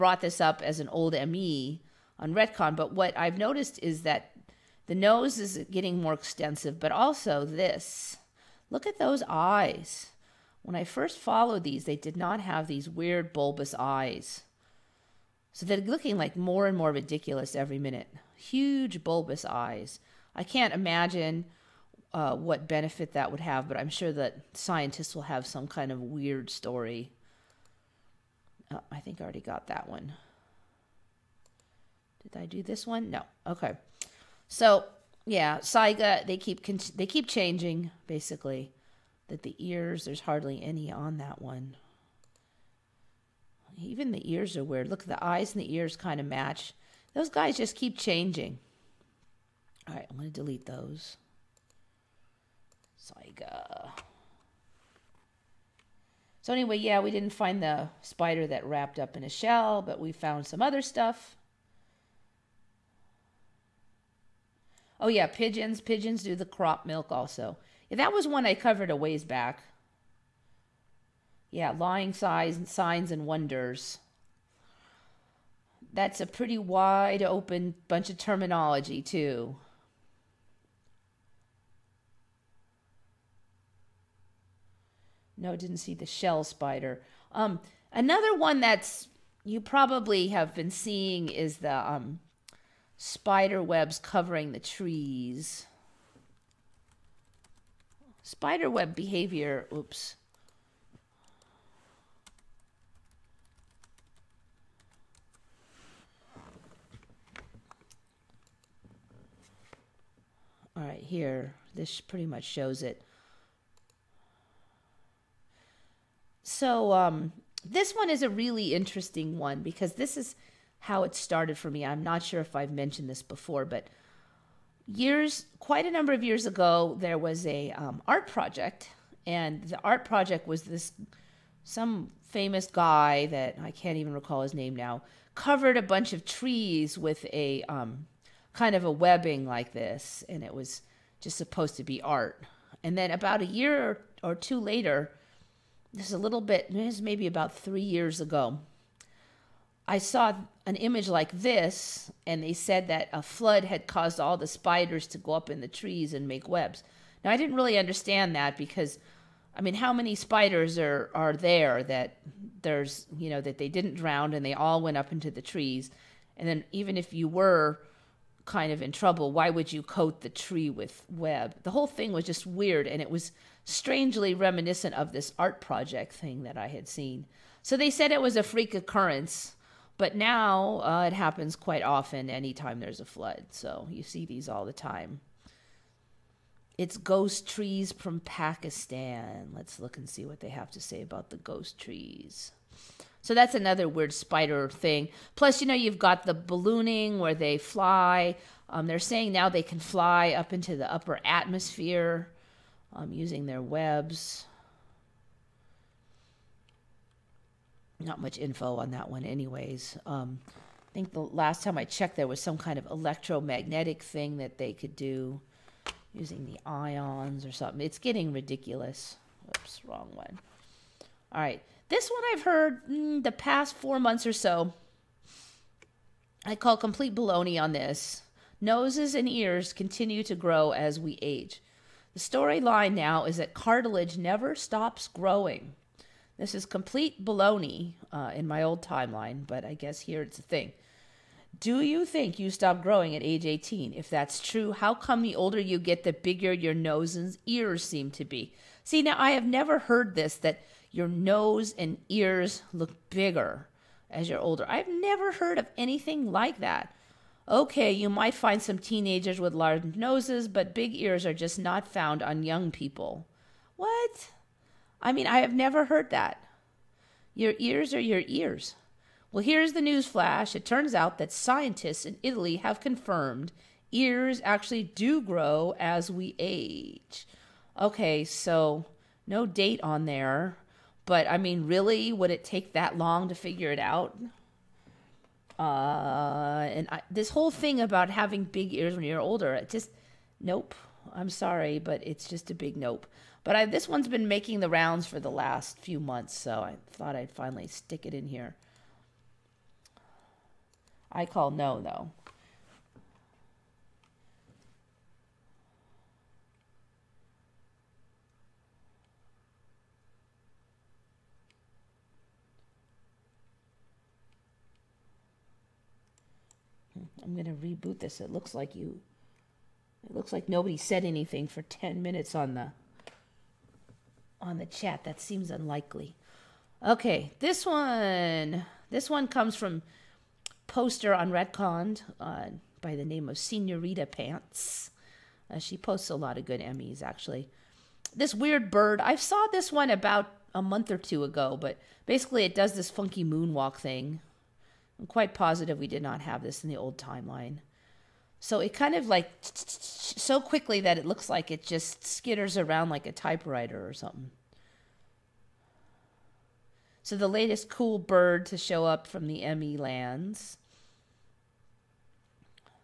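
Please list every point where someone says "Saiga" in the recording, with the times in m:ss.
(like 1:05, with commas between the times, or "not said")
0:35, 0:52.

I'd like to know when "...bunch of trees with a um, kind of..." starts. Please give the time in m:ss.
2:15.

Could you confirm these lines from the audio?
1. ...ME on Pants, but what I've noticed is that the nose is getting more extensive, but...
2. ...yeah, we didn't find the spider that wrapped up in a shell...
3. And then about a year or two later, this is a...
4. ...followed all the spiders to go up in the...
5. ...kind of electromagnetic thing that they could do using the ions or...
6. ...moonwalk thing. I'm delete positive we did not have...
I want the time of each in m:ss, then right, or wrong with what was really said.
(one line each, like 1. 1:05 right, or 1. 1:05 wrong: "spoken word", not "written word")
1. 0:01 wrong: "Retcon", not "Pants"
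2. 0:56 right
3. 2:22 right
4. 2:33 wrong: "caused", not "followed"
5. 3:32 right
6. 5:43 wrong: "quite", not "delete".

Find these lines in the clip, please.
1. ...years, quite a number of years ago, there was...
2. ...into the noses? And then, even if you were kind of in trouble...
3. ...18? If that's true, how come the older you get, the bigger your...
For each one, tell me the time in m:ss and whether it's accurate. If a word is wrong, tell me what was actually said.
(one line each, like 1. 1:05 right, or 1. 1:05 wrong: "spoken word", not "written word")
1. 2:04 right
2. 2:45 wrong: "trees", not "noses"
3. 4:03 right.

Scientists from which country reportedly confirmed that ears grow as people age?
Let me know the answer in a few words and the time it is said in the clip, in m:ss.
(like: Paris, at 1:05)
Italy, at 4:32.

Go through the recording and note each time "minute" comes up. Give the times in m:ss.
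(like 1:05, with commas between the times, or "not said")
0:17, 5:22.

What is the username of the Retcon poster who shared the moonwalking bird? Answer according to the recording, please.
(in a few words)
Senorita Pants.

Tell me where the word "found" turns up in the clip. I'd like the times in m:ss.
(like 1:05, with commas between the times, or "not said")
1:00, 4:21.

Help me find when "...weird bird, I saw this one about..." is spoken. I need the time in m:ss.
5:38.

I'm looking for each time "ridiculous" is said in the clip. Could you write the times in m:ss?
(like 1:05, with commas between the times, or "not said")
0:16, 3:38.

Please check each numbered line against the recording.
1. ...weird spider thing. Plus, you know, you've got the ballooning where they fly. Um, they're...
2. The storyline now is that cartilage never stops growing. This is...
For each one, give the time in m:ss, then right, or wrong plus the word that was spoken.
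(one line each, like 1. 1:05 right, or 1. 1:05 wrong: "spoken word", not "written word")
1. 3:13 right
2. 3:52 right.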